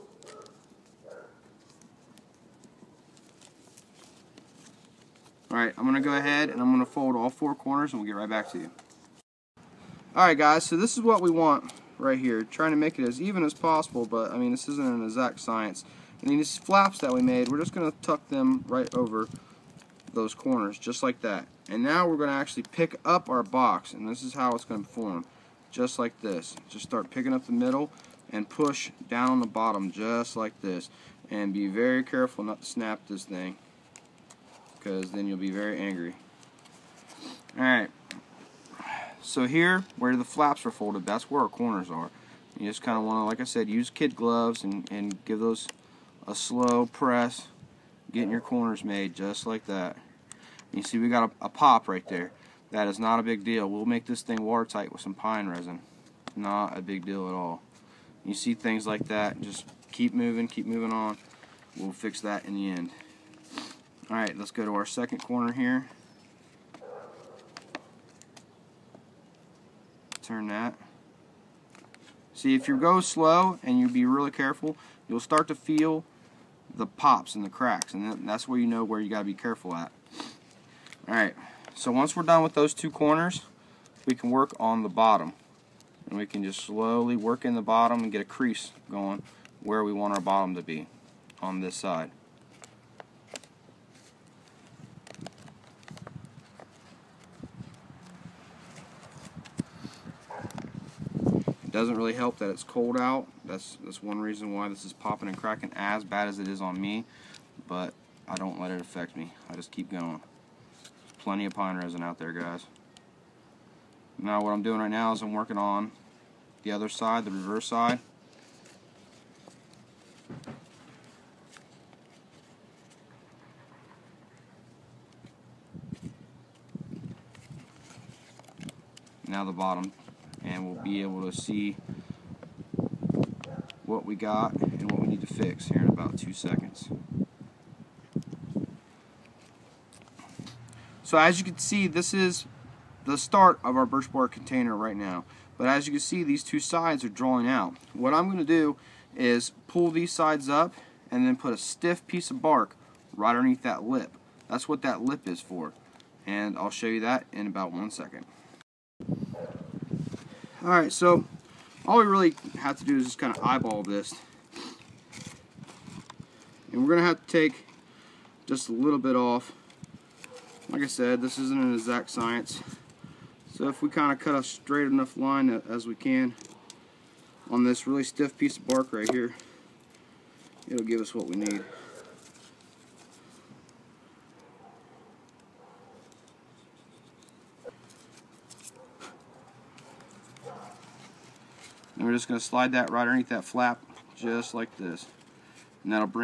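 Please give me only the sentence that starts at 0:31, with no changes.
And be very careful not to snap this thing because then you'll be very angry.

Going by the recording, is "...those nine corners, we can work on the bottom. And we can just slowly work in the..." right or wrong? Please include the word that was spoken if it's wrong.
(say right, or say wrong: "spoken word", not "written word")
wrong: "two", not "nine".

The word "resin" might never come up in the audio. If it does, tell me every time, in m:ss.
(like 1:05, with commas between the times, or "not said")
0:55, 1:51.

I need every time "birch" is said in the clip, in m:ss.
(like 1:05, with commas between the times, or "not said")
2:23.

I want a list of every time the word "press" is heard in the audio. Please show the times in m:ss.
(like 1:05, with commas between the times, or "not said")
0:46.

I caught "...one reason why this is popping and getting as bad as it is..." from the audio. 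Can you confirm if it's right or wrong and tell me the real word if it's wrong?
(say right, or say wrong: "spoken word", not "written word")
wrong: "cracking", not "getting".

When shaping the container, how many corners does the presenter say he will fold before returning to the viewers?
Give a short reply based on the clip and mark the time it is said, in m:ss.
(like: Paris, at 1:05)
4, at 0:07.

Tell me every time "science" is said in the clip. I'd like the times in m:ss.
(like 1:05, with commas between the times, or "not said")
0:15, 2:52.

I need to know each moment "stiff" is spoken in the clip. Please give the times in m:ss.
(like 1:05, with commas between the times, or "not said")
2:31, 2:58.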